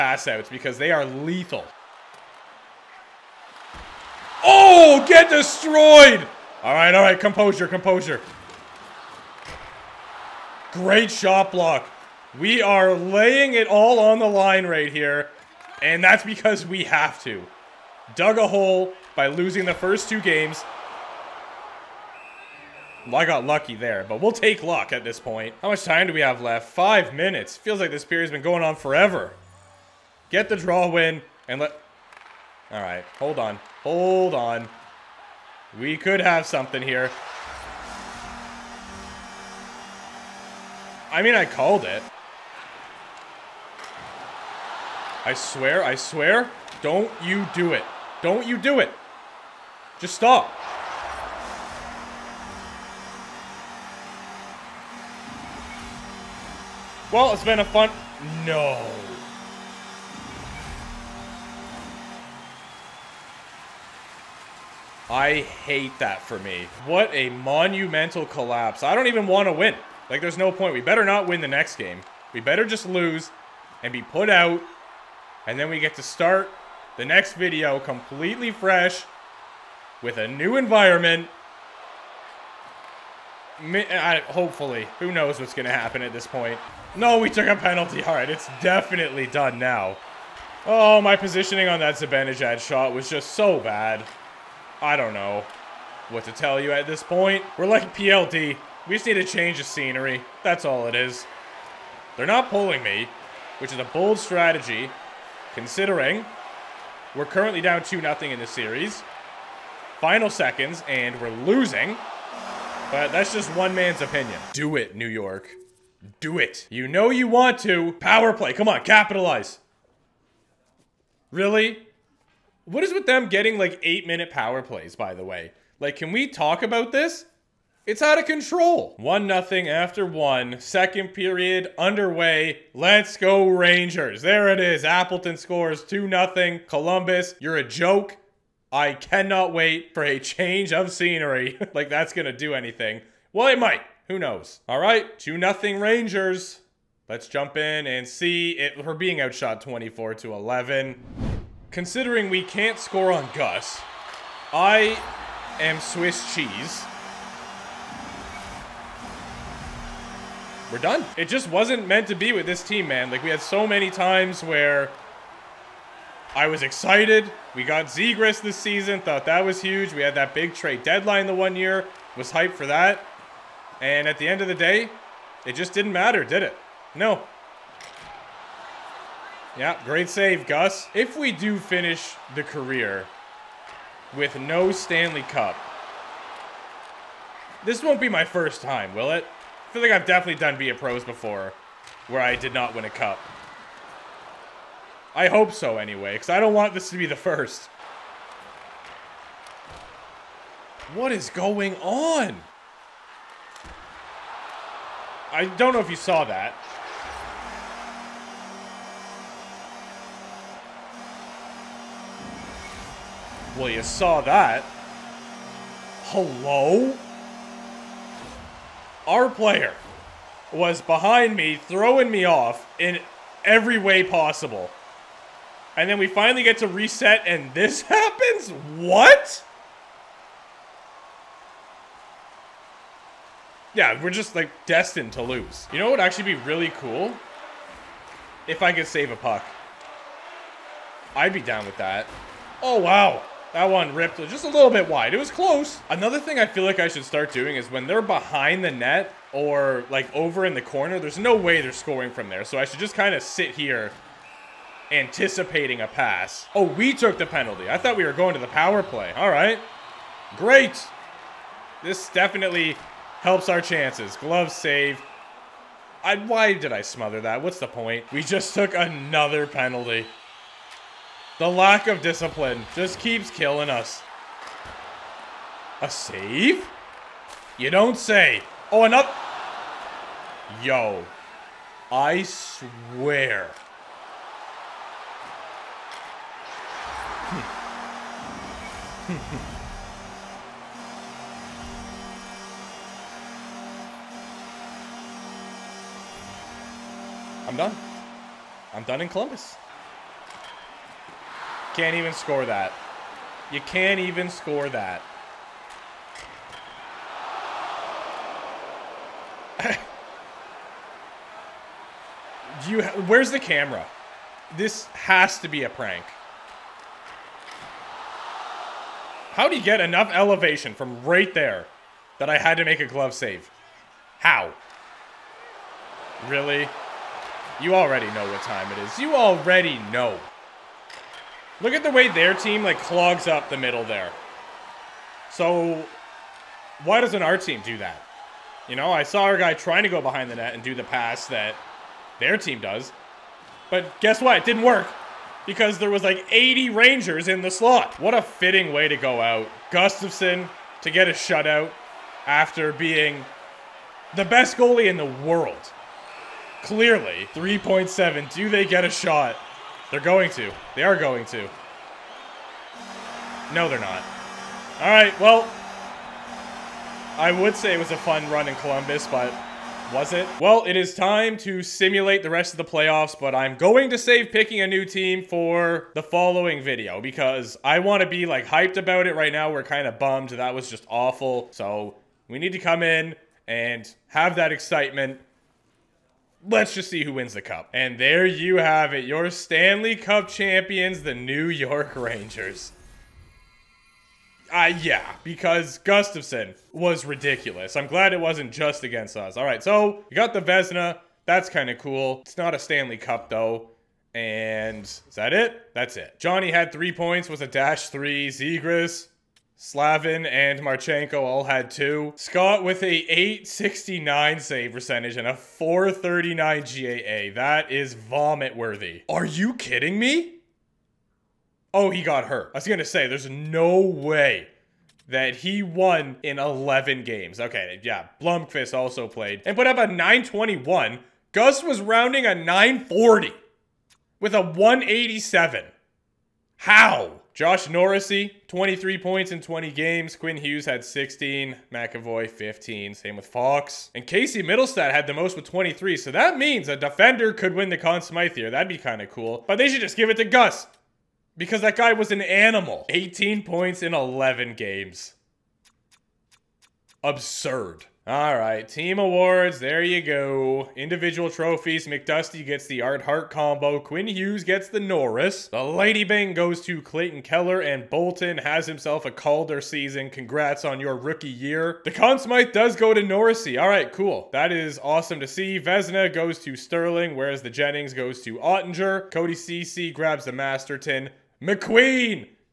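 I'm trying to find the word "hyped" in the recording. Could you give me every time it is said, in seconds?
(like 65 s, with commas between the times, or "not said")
172 s, 378 s.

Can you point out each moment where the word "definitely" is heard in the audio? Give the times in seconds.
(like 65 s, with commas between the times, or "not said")
88 s, 190 s, 262 s.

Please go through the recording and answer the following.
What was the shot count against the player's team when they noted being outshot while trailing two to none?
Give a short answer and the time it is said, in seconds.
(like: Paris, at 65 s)
24 to 11, at 149 s.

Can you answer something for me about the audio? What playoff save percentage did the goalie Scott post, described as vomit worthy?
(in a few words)
869.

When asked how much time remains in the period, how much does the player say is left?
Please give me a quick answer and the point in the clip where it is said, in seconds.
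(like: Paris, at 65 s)
5 minutes, at 26 s.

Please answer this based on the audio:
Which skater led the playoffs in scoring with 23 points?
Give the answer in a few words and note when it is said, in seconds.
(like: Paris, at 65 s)
Casey Mittelstadt, at 444 s.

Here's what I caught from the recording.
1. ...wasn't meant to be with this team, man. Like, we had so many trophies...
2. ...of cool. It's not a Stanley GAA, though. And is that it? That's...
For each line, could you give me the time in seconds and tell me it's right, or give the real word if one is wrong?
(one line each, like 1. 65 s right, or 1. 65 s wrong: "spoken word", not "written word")
1. 161 s wrong: "times", not "trophies"
2. 401 s wrong: "Cup", not "GAA".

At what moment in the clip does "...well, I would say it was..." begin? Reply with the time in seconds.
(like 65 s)
365 s.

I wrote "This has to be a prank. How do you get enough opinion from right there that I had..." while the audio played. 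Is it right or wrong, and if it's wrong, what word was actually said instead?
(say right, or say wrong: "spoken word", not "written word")
wrong: "elevation", not "opinion".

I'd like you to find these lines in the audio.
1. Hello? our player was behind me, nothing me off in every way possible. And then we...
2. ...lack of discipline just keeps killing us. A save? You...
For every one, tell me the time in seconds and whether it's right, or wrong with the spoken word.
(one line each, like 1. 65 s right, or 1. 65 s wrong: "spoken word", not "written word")
1. 216 s wrong: "throwing", not "nothing"
2. 271 s right.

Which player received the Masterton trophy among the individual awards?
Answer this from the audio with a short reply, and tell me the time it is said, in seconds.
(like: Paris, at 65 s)
Cody Ceci, at 479 s.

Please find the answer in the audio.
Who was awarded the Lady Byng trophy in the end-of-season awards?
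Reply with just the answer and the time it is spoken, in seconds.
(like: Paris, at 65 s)
Clayton Keller, at 466 s.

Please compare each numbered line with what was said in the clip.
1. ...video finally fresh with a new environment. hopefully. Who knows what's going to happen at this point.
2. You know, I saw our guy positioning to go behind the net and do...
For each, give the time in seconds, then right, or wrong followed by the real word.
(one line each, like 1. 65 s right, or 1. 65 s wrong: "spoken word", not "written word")
1. 77 s wrong: "completely", not "finally"
2. 338 s wrong: "trying", not "positioning".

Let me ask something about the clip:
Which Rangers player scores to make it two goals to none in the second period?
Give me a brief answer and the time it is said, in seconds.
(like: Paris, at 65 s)
Appleton, at 134 s.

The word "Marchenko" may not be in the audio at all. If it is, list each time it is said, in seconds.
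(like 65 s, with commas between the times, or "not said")
410 s.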